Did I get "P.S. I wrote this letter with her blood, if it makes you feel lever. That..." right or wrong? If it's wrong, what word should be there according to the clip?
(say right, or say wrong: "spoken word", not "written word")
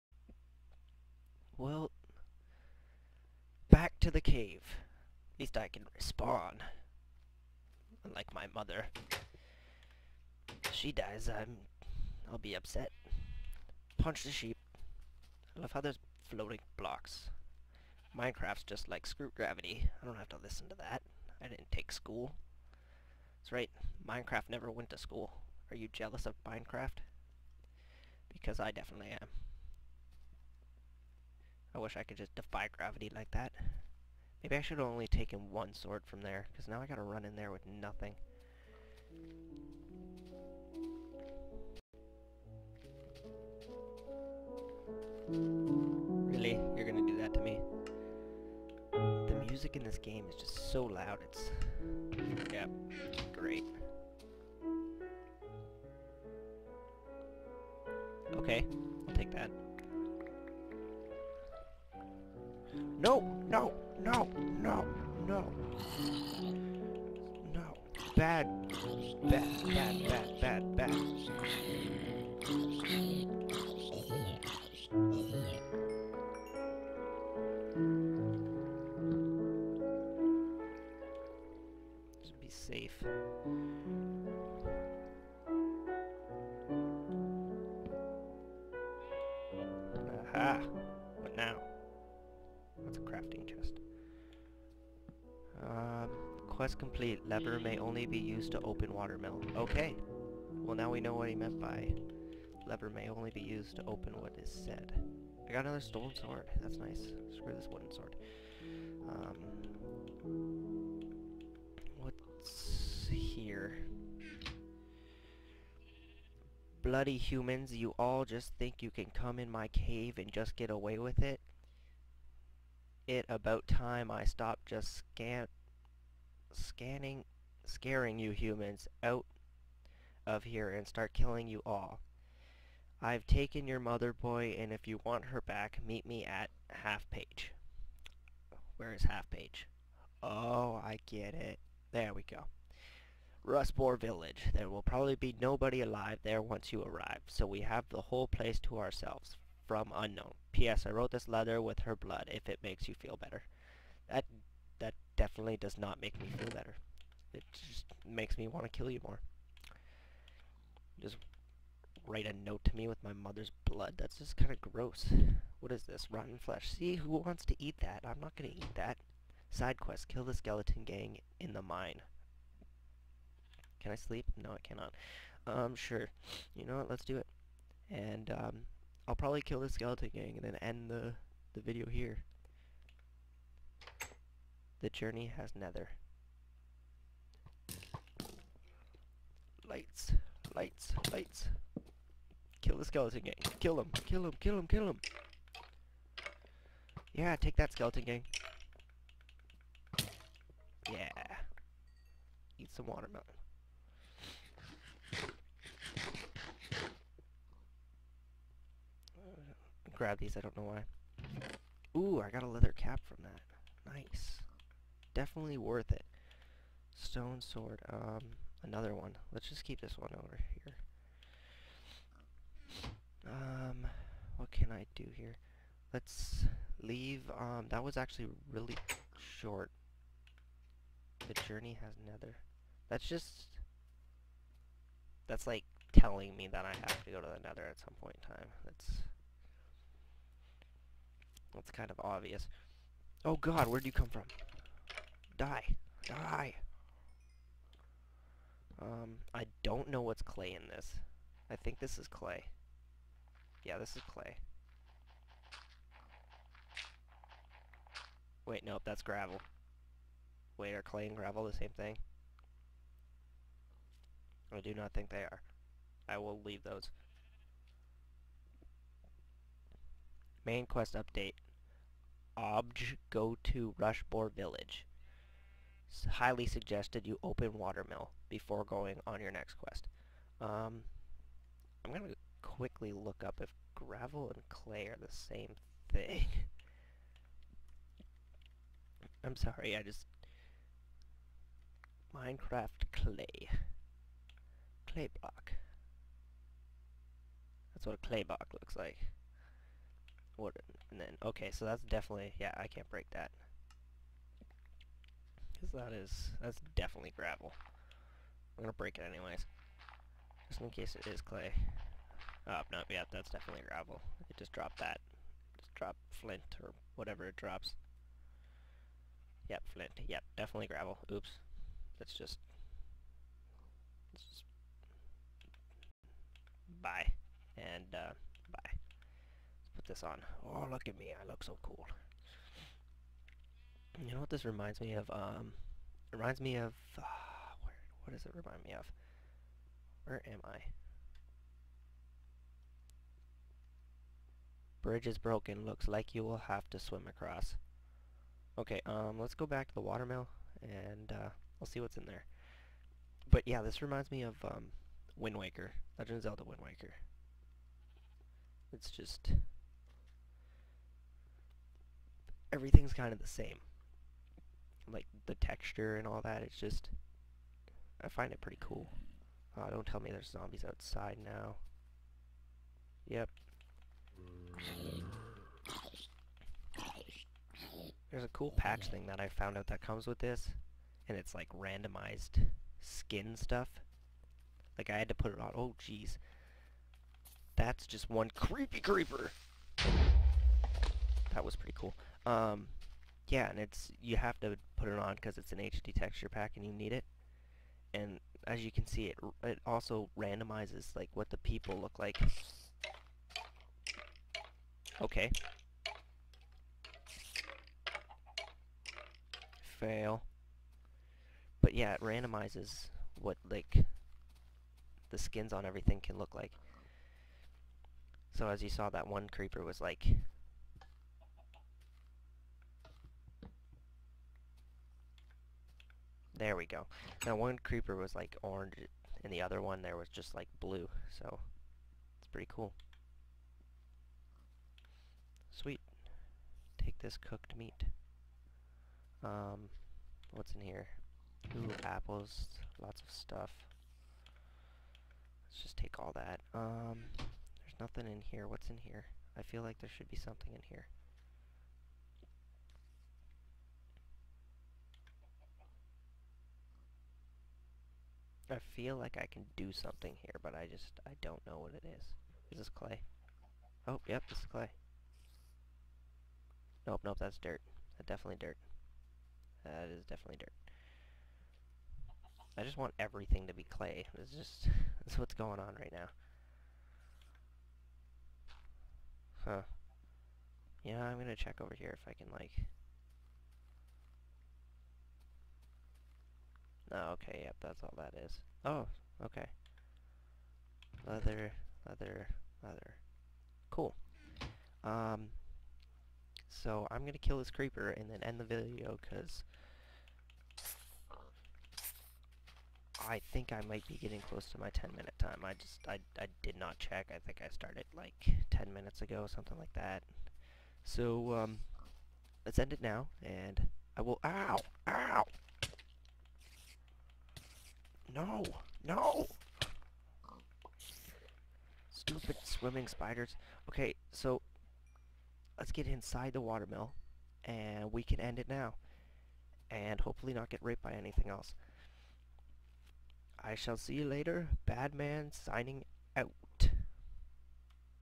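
wrong: "better", not "lever".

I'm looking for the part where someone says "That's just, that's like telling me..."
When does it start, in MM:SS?
03:52.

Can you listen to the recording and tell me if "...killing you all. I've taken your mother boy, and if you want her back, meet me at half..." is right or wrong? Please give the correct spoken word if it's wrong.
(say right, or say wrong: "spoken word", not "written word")
right.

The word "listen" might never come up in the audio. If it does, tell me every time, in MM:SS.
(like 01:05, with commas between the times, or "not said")
00:20.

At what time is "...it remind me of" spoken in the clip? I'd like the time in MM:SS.
05:38.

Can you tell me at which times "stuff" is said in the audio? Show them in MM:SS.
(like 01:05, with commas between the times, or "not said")
06:23, 07:23.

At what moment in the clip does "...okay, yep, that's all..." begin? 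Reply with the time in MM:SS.
08:07.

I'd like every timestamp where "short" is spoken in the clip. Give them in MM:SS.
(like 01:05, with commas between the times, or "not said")
03:49.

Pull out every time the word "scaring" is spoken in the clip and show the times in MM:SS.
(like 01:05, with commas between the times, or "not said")
02:07.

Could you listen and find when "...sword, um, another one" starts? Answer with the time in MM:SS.
03:37.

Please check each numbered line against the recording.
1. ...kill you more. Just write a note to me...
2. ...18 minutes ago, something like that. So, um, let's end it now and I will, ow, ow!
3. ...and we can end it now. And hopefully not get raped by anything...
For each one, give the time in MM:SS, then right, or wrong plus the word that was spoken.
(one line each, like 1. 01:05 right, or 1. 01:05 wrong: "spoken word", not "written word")
1. 02:38 right
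2. 08:28 wrong: "10", not "18"
3. 08:47 right.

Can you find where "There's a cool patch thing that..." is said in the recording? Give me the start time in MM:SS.
06:18.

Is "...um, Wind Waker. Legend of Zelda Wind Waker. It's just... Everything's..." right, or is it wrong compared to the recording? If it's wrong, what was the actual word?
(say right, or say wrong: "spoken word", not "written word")
right.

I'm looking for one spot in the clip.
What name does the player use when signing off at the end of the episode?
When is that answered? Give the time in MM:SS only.
08:54.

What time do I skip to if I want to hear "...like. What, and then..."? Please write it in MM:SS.
04:58.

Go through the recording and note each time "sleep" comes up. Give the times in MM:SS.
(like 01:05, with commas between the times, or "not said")
02:53.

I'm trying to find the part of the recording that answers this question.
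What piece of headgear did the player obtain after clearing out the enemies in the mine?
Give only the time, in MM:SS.
03:32.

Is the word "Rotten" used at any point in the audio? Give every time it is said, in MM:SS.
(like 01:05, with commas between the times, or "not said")
02:46.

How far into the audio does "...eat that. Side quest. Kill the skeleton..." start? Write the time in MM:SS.
02:48.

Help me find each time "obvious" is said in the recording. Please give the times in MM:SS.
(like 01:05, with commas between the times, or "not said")
04:02.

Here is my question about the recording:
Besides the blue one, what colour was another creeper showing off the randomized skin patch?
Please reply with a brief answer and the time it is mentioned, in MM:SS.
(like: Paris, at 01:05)
orange, at 07:08.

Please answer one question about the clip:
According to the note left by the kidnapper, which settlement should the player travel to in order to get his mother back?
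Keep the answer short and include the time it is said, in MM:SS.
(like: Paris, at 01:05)
Rustbore Village, at 02:23.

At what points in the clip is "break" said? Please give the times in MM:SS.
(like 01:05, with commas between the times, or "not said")
05:02, 05:08.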